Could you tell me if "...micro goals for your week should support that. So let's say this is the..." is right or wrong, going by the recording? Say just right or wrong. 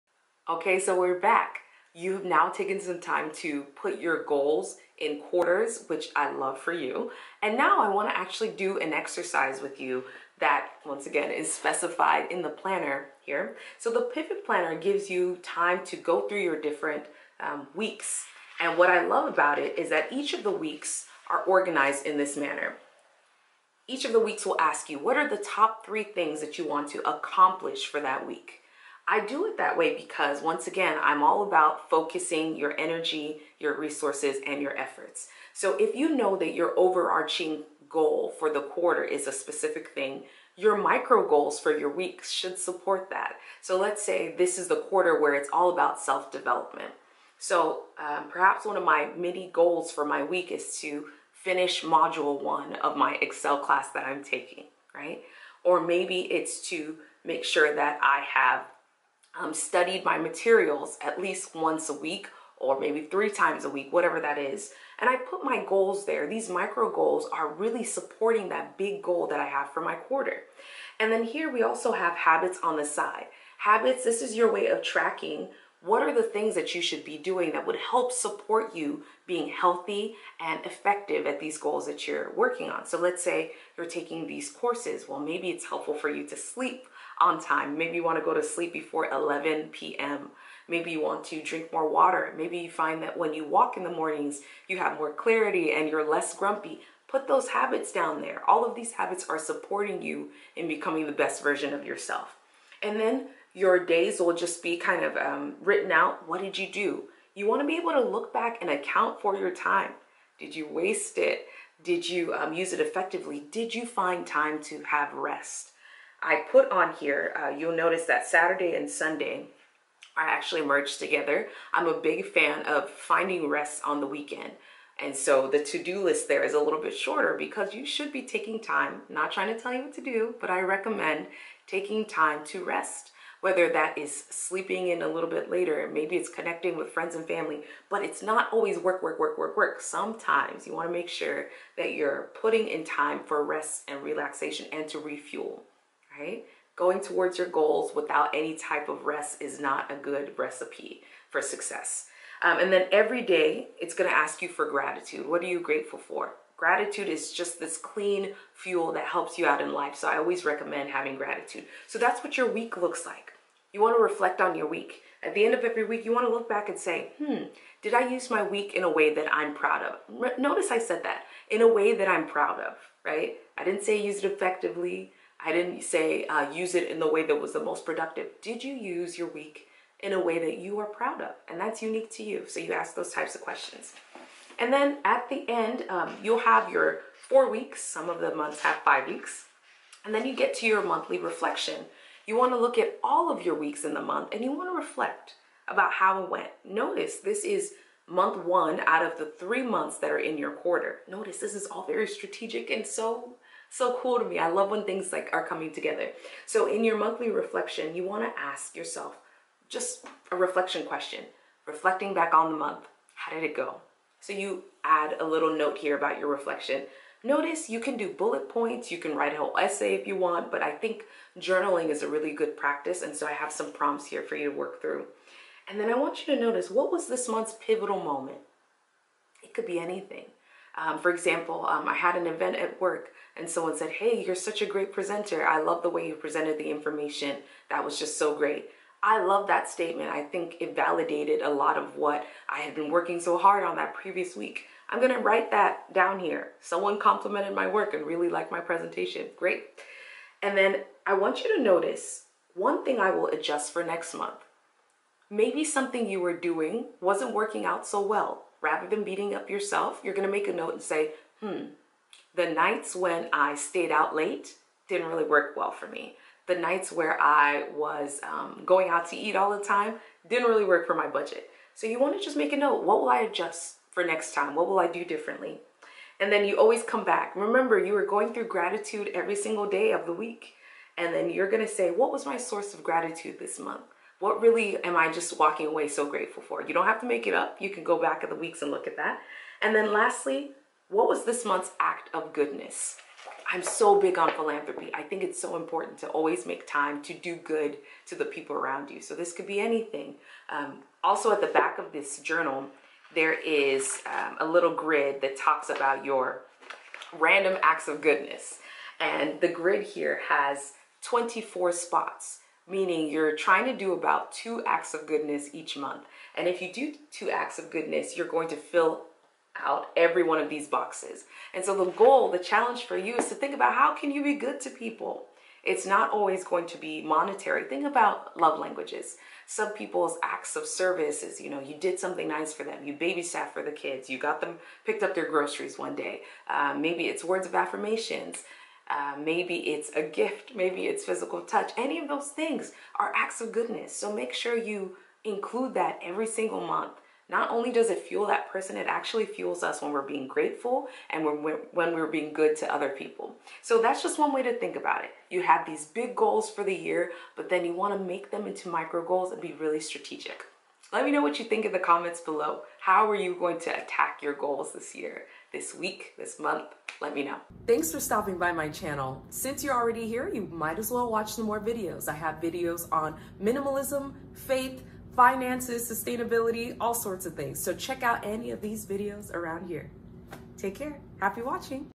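right.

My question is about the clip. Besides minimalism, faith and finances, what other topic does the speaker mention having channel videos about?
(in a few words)
Sustainability.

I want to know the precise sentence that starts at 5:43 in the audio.
So make sure you include that every single month.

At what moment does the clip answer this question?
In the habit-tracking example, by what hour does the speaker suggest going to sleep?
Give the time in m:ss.
1:29.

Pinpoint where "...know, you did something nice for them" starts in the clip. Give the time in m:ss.
5:31.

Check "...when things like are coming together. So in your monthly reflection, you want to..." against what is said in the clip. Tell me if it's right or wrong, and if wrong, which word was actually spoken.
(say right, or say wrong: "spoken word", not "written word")
right.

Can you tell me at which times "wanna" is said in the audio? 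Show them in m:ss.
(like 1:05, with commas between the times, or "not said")
0:07, 2:20.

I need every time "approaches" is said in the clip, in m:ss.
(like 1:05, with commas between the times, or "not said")
not said.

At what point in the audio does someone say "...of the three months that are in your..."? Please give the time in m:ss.
3:19.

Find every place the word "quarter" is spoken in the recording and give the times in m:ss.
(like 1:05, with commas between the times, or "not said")
0:05, 0:38, 0:44, 1:09, 3:20.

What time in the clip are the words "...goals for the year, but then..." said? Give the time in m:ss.
5:56.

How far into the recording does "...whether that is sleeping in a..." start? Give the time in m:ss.
2:13.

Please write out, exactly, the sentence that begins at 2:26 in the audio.
Going towards your goals without any type of rest is not a good recipe for success.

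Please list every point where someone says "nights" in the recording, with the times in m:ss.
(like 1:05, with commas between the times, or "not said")
4:22, 4:26.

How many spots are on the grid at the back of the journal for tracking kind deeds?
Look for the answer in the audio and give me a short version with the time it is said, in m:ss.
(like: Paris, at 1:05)
24, at 5:11.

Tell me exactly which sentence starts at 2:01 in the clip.
I'm a big fan of finding rest on the weekend.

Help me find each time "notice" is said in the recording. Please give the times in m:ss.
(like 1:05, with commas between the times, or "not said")
1:57, 2:50, 3:16, 3:21, 3:37, 3:46, 4:11.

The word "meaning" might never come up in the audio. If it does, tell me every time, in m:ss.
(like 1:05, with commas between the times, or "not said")
5:12.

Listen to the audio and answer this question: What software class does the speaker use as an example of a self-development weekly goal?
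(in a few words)
Excel.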